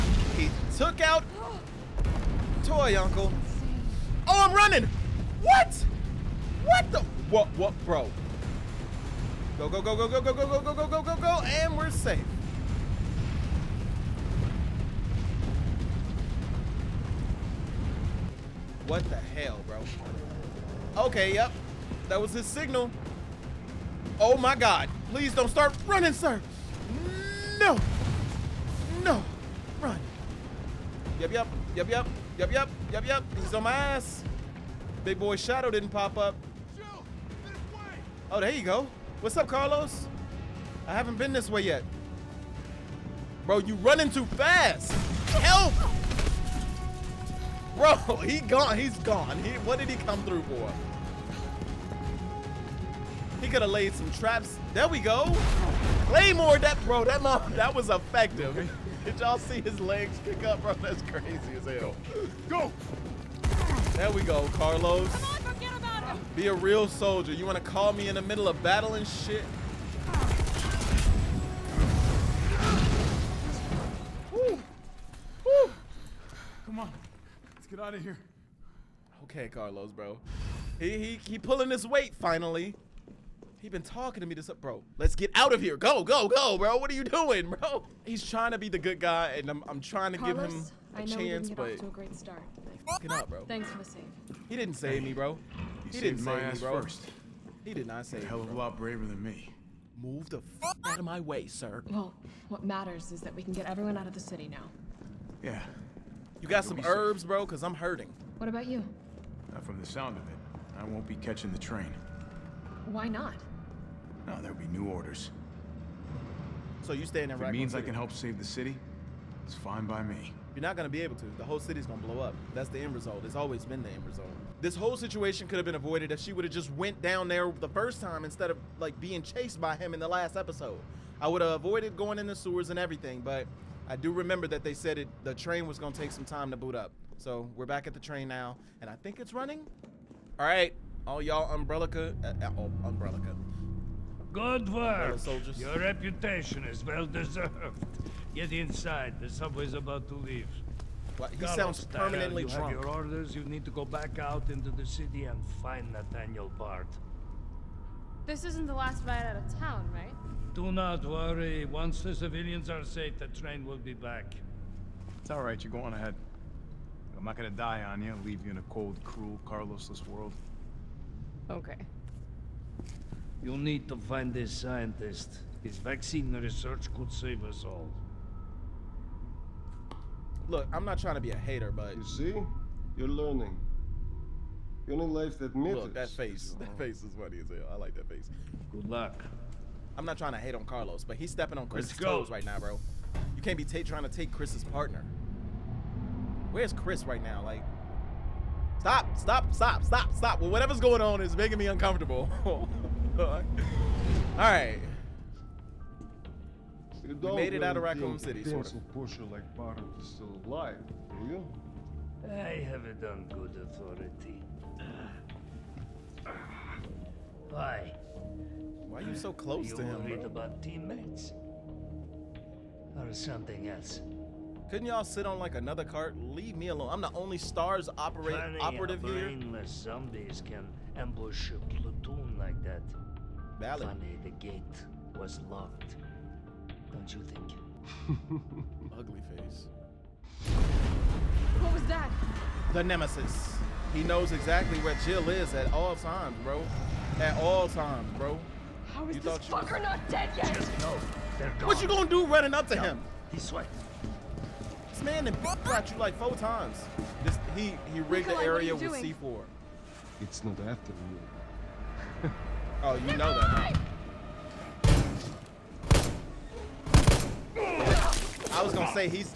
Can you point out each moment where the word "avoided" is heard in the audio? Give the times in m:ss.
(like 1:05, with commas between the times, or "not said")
2:05, 2:11.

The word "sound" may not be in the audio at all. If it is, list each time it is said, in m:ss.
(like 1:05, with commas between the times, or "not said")
1:49, 2:31.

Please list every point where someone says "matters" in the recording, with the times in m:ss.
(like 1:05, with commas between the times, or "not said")
1:42, 3:05.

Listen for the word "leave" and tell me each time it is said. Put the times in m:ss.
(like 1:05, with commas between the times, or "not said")
2:30, 2:48, 3:46.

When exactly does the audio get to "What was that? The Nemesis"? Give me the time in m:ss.
4:01.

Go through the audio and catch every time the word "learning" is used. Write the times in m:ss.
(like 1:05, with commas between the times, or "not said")
3:03.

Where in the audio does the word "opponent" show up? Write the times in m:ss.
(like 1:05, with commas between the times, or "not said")
not said.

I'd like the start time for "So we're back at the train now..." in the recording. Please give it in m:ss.
2:17.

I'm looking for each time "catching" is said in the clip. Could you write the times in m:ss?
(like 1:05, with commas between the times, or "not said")
1:51.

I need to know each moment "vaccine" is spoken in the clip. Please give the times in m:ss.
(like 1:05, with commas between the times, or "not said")
2:55.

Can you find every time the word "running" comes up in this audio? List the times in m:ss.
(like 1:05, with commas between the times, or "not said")
0:04, 0:25, 0:43, 2:19, 4:12.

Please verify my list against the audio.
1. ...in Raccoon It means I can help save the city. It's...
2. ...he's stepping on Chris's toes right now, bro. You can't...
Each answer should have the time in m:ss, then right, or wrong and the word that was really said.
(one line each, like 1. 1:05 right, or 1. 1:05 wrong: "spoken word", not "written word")
1. 1:57 right
2. 3:11 right.